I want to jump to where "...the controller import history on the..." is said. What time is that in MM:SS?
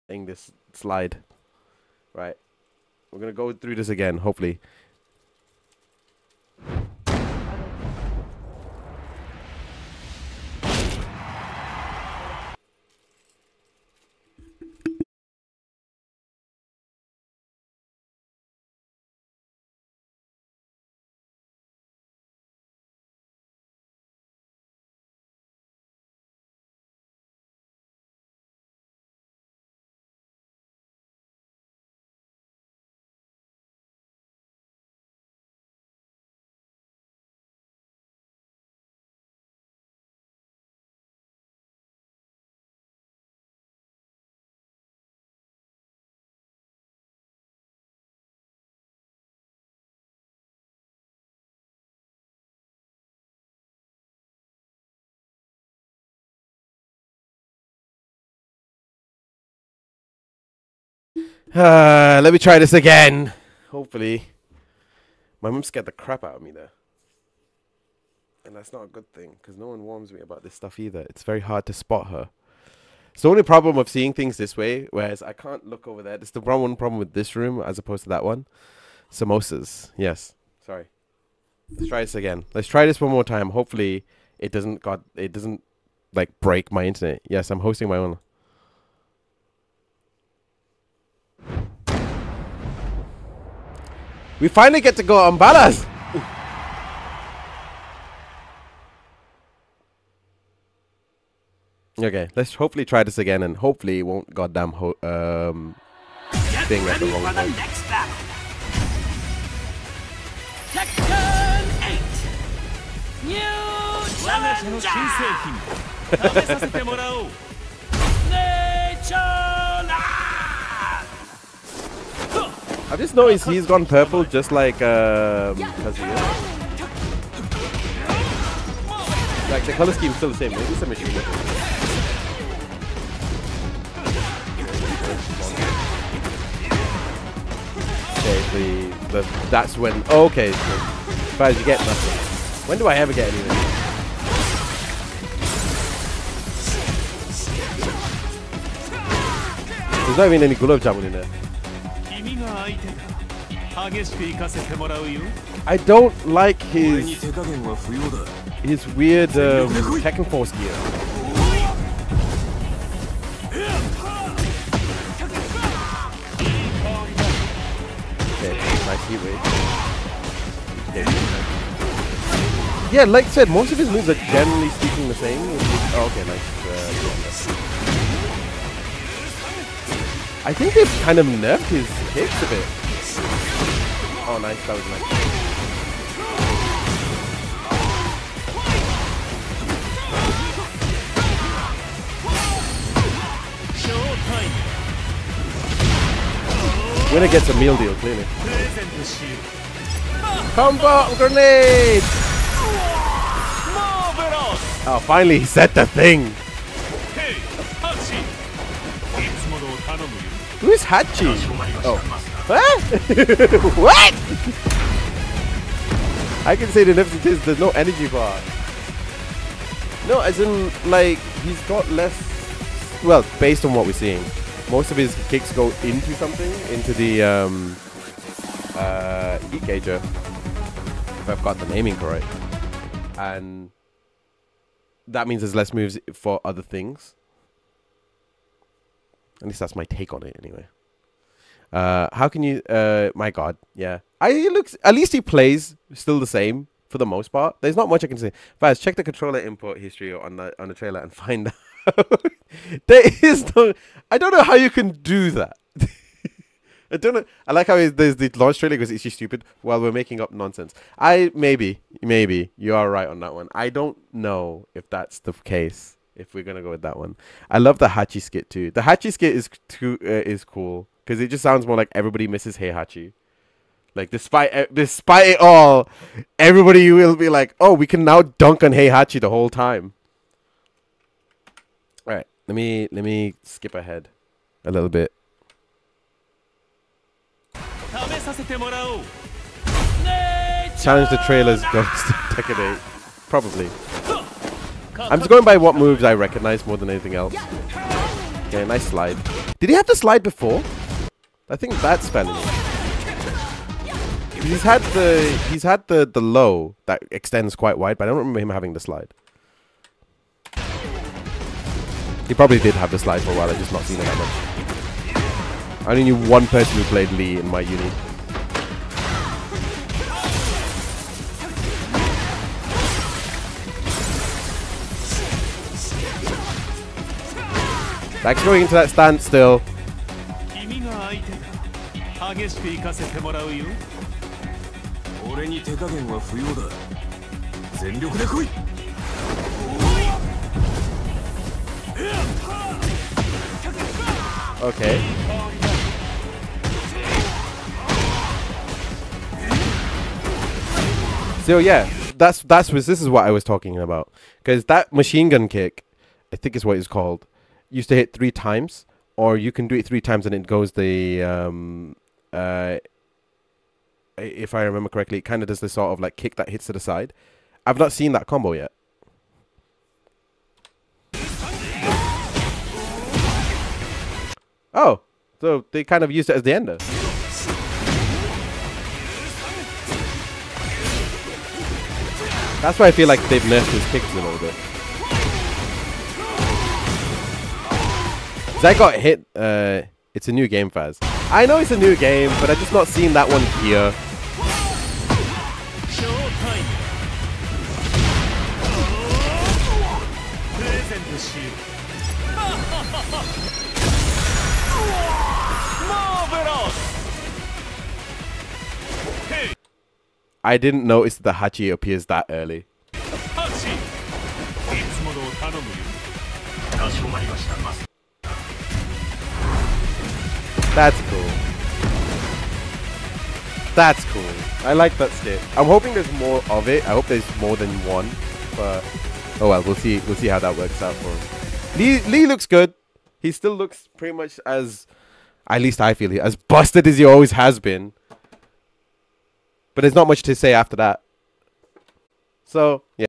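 04:08.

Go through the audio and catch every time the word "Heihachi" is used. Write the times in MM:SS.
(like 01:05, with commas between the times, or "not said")
04:32, 04:38.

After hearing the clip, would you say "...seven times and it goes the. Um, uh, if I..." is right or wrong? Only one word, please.
wrong.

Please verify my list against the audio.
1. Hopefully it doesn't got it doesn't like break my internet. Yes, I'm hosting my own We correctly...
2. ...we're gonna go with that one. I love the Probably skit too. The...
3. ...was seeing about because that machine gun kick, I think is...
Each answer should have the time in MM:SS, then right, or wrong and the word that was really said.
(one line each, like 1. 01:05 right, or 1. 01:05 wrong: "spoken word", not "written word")
1. 01:23 wrong: "finally", not "correctly"
2. 04:26 wrong: "Hachi", not "Probably"
3. 05:53 wrong: "talking", not "seeing".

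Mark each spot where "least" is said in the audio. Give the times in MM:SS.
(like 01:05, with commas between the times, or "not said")
03:59, 04:04, 07:15.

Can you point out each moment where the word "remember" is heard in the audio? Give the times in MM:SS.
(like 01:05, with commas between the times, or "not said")
05:08, 06:04.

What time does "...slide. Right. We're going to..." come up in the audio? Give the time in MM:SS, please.
00:00.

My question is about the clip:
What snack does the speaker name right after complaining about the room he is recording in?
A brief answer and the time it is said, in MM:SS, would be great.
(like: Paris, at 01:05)
Samosas, at 01:19.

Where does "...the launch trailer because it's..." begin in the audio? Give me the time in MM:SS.
04:18.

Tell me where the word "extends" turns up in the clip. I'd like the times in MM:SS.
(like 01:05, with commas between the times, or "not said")
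05:07.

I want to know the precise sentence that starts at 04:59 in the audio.
Did he have the slide before?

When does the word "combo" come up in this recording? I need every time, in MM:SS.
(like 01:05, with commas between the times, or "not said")
03:20, 06:08.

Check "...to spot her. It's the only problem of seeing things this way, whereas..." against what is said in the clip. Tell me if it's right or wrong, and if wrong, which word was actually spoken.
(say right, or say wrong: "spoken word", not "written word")
right.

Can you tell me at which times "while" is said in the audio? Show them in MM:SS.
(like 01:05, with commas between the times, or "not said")
04:19, 05:13.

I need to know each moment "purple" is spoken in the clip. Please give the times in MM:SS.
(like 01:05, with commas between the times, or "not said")
02:03.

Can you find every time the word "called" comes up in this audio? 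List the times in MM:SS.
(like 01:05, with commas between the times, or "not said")
05:56.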